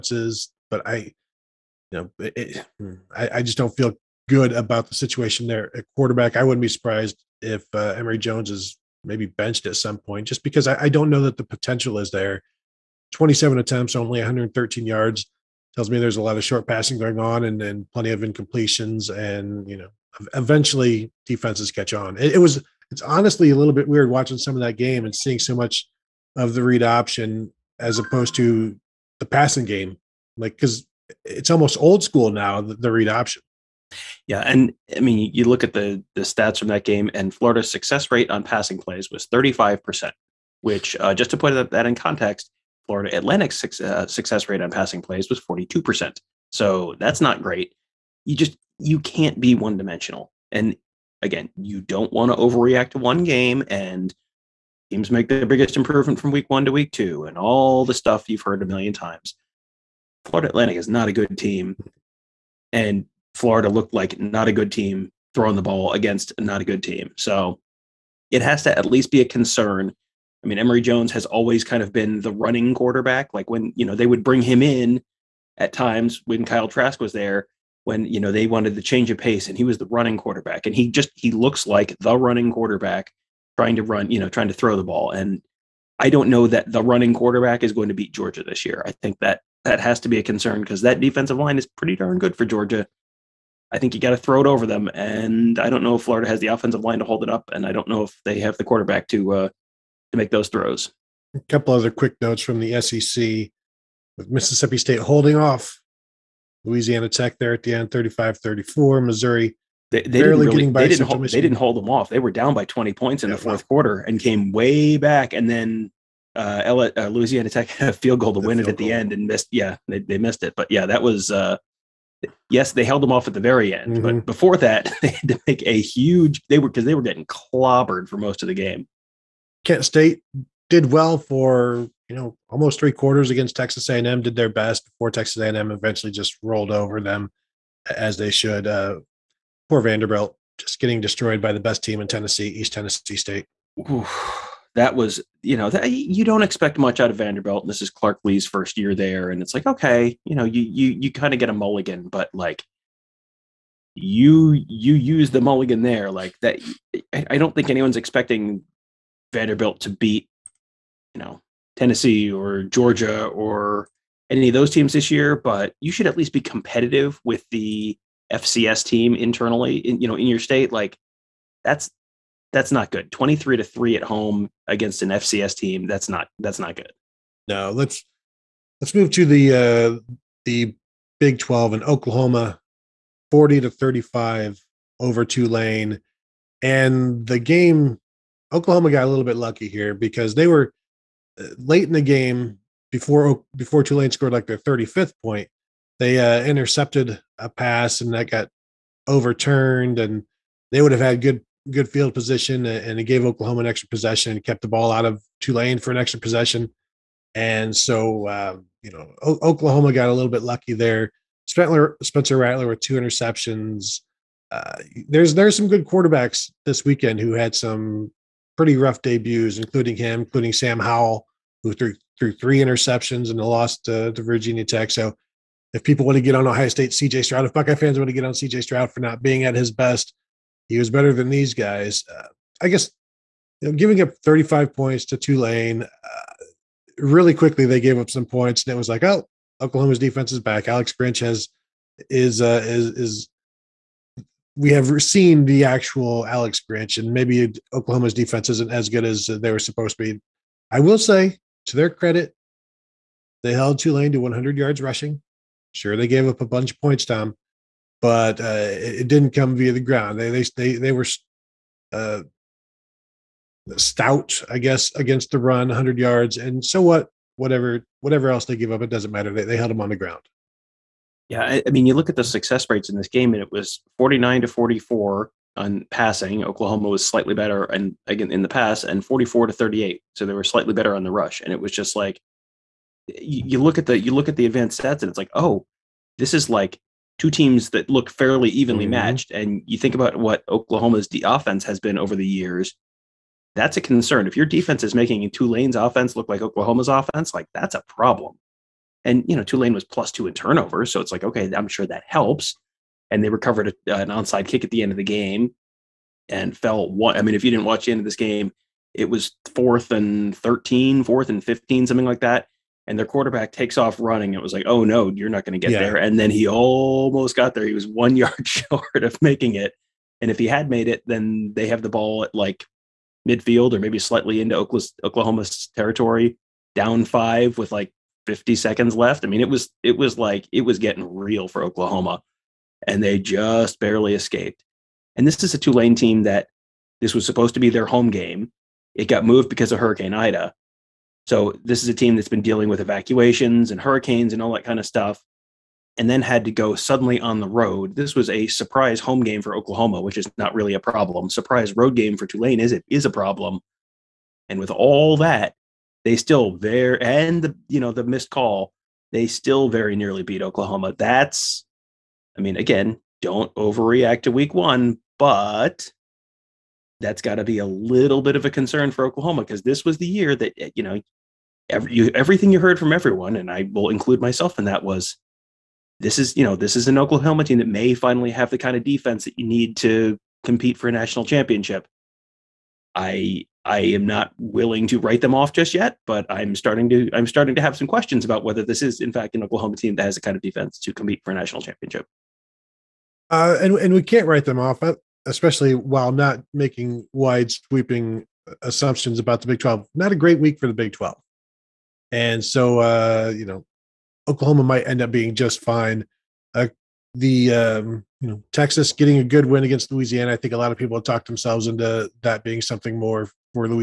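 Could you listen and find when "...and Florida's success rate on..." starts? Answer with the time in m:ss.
0:37.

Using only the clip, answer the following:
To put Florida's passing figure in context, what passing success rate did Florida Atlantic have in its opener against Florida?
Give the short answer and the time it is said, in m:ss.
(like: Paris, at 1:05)
42%, at 0:45.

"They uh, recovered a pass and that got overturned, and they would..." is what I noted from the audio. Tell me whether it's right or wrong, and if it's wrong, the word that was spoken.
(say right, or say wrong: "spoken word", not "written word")
wrong: "intercepted", not "recovered".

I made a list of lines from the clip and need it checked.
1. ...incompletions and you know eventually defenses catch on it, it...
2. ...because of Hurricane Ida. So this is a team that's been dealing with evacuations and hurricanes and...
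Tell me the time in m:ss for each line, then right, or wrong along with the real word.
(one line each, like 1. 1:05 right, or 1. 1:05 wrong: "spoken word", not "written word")
1. 0:18 right
2. 5:39 right.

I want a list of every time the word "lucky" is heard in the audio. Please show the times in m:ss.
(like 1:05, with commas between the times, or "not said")
3:09, 3:30.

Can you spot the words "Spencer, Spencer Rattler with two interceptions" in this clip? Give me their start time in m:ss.
3:31.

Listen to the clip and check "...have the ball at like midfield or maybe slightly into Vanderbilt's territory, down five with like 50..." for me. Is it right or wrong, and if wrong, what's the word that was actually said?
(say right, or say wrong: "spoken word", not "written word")
wrong: "Oklahoma", not "Vanderbilt".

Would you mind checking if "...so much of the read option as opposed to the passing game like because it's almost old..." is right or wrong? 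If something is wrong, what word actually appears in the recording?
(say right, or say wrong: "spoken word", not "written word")
right.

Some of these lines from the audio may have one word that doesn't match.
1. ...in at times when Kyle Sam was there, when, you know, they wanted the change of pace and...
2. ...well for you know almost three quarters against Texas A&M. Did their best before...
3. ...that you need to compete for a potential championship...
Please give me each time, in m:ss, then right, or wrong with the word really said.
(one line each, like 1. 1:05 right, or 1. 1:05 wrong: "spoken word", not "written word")
1. 1:14 wrong: "Trask", not "Sam"
2. 2:10 right
3. 6:19 wrong: "national", not "potential".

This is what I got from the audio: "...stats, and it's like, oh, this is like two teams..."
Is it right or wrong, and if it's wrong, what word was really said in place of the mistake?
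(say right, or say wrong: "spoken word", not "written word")
right.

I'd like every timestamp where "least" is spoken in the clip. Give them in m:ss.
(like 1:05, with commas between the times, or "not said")
1:08, 2:46.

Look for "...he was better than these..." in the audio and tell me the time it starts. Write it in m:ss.
3:50.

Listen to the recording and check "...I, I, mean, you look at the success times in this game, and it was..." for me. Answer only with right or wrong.
wrong.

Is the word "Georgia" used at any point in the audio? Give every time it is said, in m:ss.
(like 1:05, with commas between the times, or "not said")
1:28, 1:32, 2:42.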